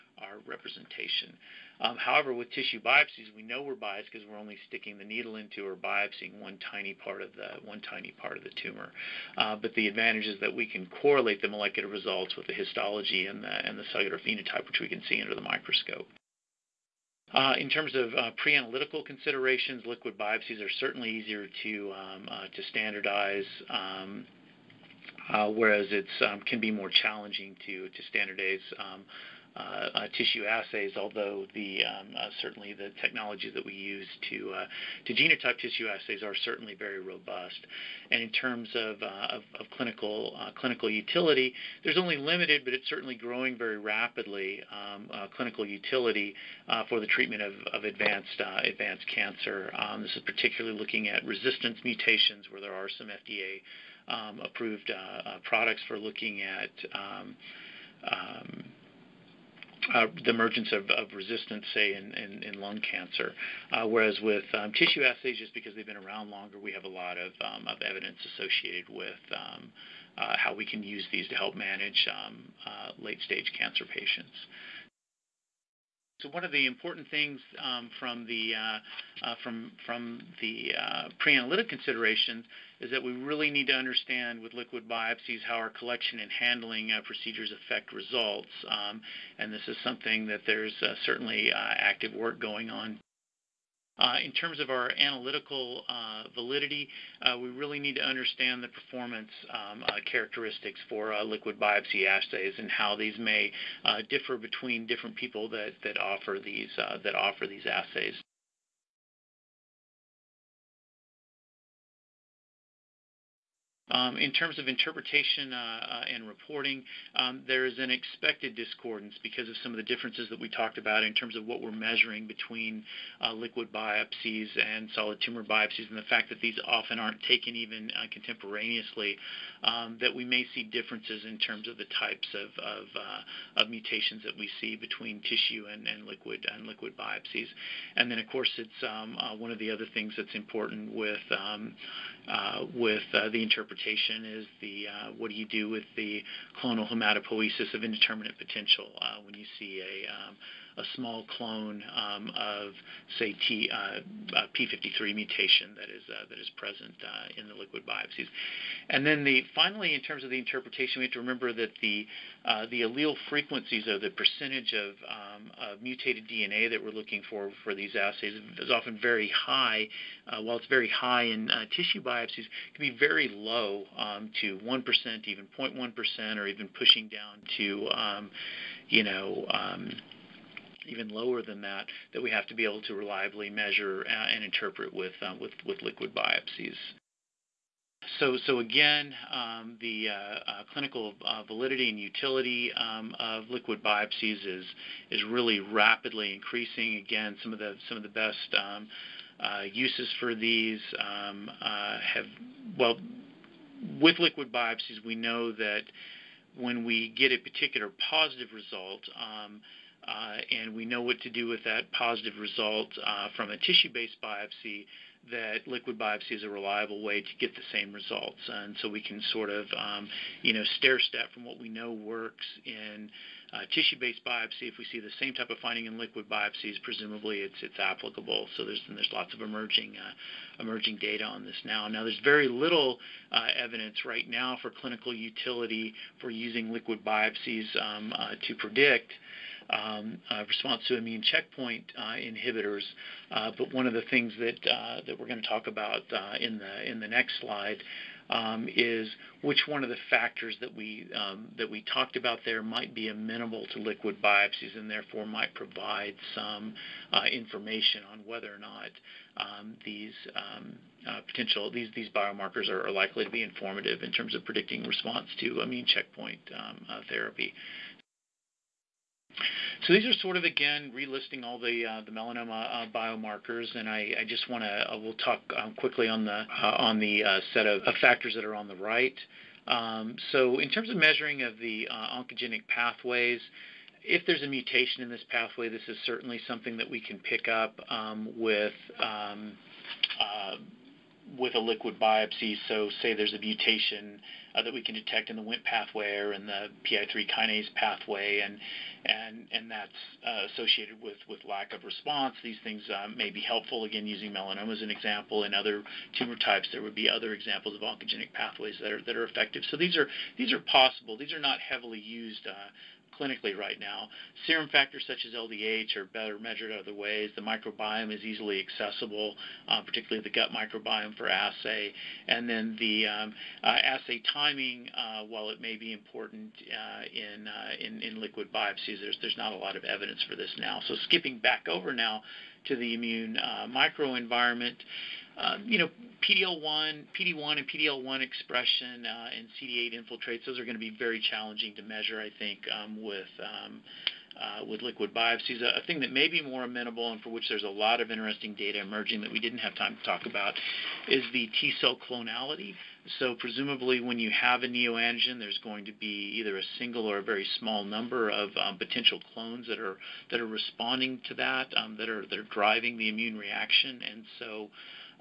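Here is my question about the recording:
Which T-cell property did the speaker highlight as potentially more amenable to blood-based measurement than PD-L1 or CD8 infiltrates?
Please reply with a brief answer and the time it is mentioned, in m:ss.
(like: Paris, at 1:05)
T-cell clonality, at 5:51.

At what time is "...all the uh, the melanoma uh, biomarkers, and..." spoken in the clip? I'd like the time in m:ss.
4:31.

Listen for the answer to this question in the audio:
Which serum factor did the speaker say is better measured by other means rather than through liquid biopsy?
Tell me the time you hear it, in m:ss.
5:15.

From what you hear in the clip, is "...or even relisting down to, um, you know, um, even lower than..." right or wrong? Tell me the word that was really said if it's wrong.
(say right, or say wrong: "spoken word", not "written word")
wrong: "pushing", not "relisting".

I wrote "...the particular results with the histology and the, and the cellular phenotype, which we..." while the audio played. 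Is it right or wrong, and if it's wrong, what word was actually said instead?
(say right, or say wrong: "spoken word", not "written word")
wrong: "molecular", not "particular".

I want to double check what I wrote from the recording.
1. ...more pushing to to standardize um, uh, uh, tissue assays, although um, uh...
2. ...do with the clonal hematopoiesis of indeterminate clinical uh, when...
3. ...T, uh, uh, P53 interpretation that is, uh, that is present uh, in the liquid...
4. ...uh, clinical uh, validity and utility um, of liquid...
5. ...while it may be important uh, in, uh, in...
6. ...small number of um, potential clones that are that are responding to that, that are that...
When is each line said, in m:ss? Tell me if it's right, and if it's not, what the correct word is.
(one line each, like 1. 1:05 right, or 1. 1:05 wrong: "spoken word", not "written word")
1. 0:26 wrong: "challenging", not "pushing"
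2. 2:25 wrong: "potential", not "clinical"
3. 2:33 wrong: "mutation", not "interpretation"
4. 3:10 right
5. 5:25 right
6. 5:57 right.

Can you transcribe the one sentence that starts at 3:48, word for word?
So there's there's lots of emerging uh, emerging data on this now.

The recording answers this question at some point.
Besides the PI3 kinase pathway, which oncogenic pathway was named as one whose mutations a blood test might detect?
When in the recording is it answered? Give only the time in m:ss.
4:55.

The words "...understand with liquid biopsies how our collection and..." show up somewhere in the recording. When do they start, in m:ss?
1:23.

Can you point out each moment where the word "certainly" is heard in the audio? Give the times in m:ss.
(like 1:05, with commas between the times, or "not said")
0:20, 0:32, 0:36, 0:42, 1:31, 4:46.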